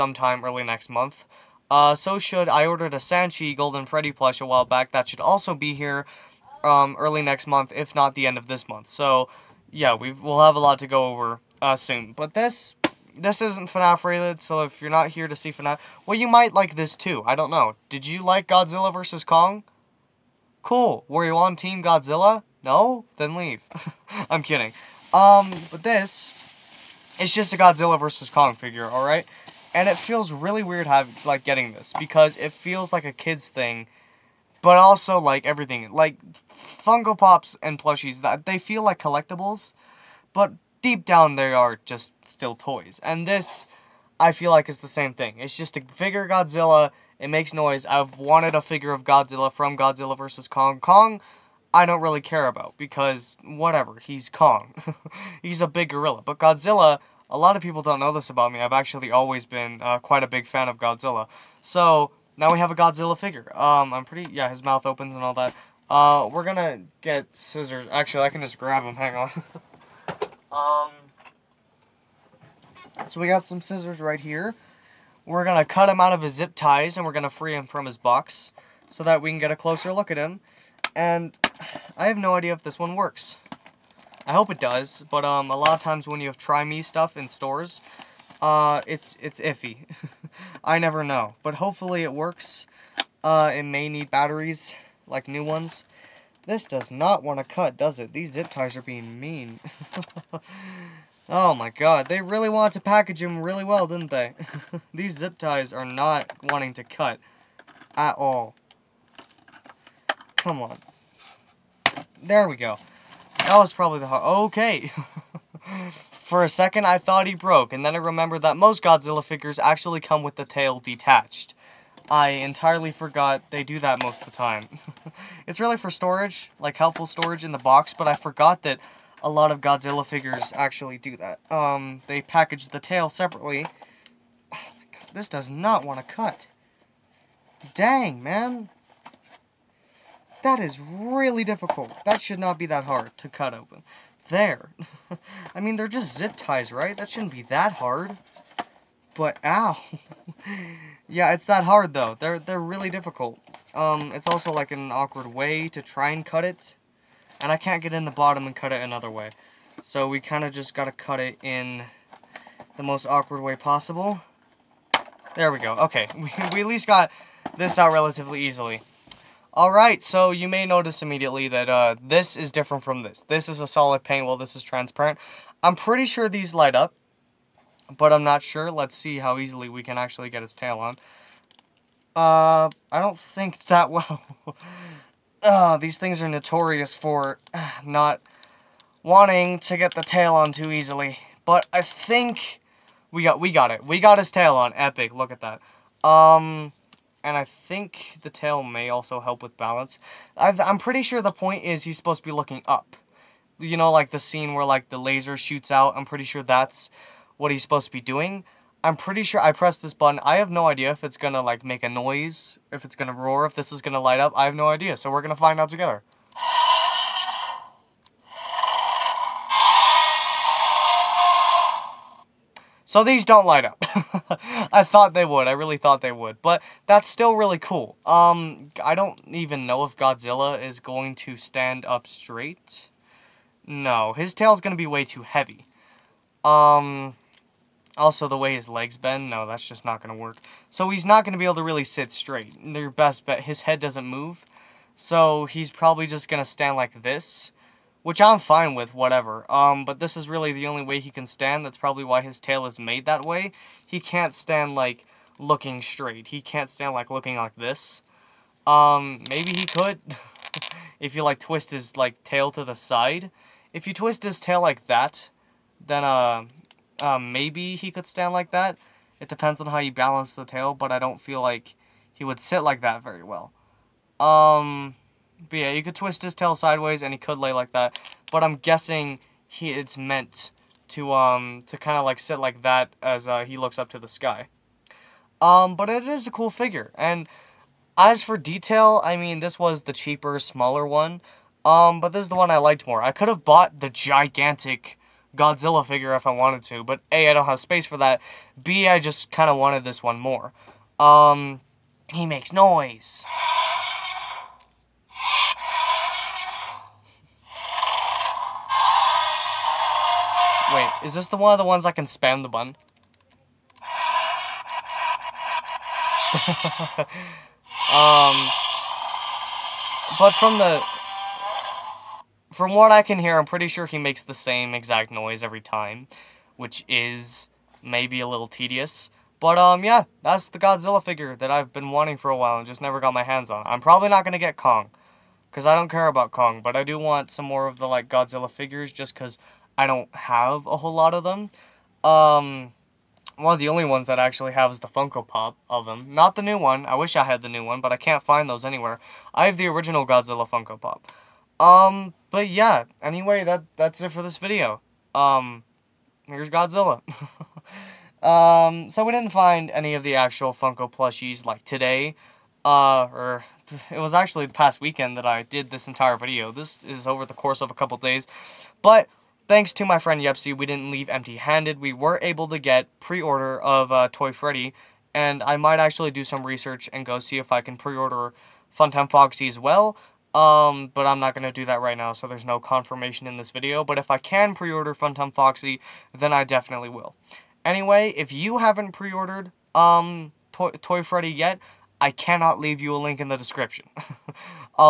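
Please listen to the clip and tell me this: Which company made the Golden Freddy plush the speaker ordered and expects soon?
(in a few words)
Sanshee.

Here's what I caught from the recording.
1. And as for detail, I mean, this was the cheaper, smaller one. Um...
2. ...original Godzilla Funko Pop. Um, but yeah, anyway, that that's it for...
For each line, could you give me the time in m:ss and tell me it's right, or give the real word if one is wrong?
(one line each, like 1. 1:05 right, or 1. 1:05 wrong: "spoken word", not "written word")
1. 4:46 right
2. 5:49 right.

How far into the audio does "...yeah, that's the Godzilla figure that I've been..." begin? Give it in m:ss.
5:29.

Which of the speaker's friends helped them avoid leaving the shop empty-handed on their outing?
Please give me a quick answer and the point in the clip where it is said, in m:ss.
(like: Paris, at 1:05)
Yepsy, at 6:10.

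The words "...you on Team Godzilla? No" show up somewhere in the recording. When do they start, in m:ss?
0:21.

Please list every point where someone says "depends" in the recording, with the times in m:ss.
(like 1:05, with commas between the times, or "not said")
4:29.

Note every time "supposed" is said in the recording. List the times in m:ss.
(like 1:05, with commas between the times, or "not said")
3:21, 3:27.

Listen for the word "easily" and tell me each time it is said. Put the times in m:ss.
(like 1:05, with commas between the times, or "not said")
2:48, 2:59, 3:10.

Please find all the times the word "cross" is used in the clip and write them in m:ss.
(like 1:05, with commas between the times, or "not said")
not said.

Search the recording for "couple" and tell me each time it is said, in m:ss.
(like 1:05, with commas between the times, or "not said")
6:07.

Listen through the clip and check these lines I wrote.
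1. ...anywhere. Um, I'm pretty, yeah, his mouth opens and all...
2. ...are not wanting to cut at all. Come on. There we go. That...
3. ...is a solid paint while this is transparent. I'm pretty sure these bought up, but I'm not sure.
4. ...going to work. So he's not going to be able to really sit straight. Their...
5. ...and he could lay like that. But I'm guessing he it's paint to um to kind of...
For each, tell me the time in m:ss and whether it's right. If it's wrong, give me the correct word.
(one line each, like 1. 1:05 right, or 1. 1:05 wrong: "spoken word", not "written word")
1. 1:03 wrong: "figure", not "anywhere"
2. 1:45 right
3. 2:53 wrong: "light", not "bought"
4. 4:00 right
5. 4:37 wrong: "meant", not "paint".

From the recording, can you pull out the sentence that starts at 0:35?
Like, Funko Pops and plushies, that they feel like collectibles, but deep down they are just still toys.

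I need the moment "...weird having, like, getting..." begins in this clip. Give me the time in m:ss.
0:30.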